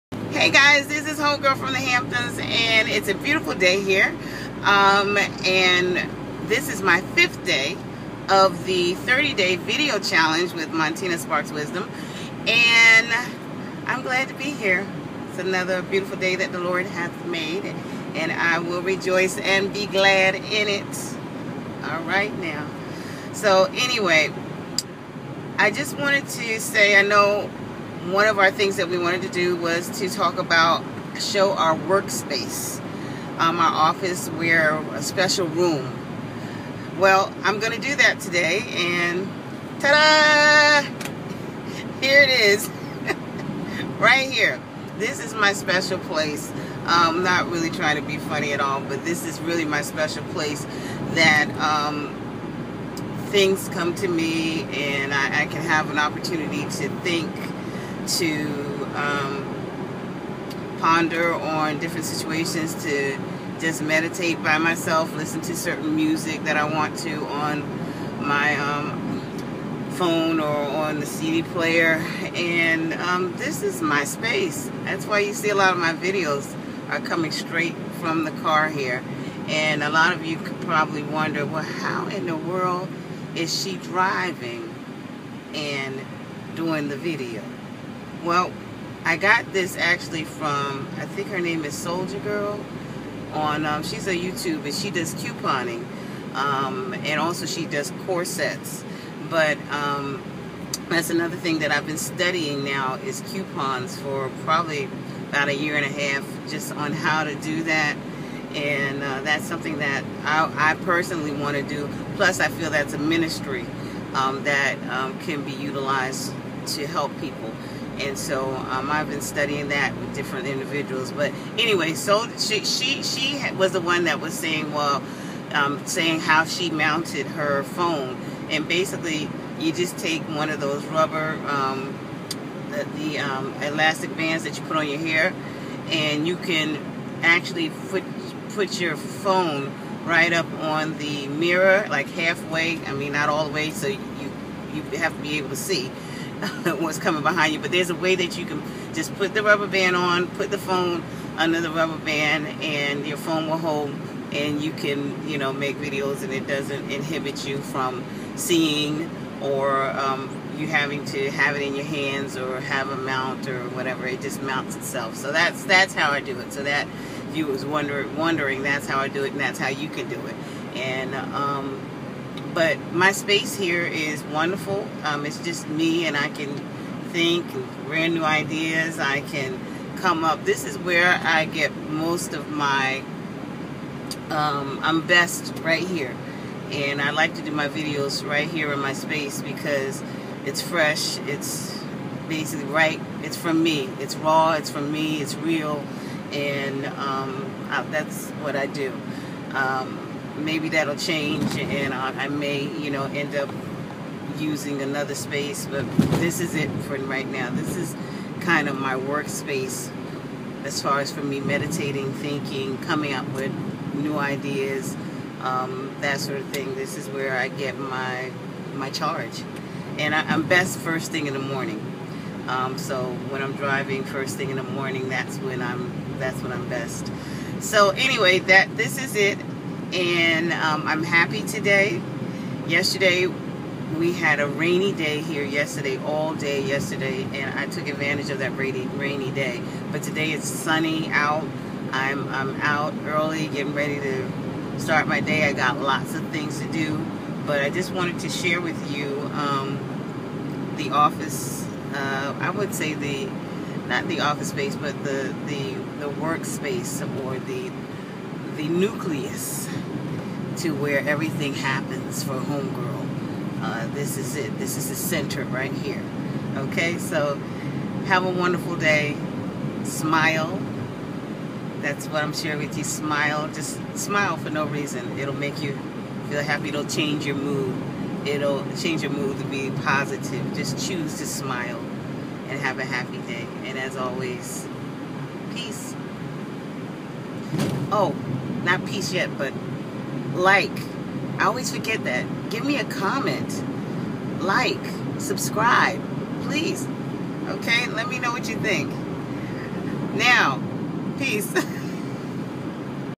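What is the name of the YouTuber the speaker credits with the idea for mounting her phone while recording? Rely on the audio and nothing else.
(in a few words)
Soldier Girl.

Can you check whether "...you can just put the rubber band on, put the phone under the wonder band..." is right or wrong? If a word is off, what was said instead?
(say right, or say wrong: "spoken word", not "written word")
wrong: "rubber", not "wonder".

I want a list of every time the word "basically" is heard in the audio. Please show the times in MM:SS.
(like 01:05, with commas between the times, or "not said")
02:08, 03:12.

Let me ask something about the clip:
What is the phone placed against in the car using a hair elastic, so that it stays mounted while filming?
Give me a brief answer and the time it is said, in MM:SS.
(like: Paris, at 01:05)
the mirror, at 02:21.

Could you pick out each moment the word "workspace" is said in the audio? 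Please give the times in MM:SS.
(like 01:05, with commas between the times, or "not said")
00:31, 03:28, 04:16.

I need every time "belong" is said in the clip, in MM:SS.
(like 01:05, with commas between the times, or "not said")
not said.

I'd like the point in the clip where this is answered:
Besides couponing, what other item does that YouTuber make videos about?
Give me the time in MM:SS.
01:38.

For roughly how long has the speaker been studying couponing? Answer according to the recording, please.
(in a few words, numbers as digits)
a year and a half.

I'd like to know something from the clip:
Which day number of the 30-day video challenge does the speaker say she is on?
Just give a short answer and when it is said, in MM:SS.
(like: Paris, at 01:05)
5th, at 00:07.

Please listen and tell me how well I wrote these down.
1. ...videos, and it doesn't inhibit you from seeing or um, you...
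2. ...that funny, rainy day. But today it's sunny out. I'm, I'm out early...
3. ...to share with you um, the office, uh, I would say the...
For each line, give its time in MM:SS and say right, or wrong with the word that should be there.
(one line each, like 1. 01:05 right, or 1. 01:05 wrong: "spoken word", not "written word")
1. 02:35 right
2. 03:58 wrong: "rainy", not "funny"
3. 04:08 right.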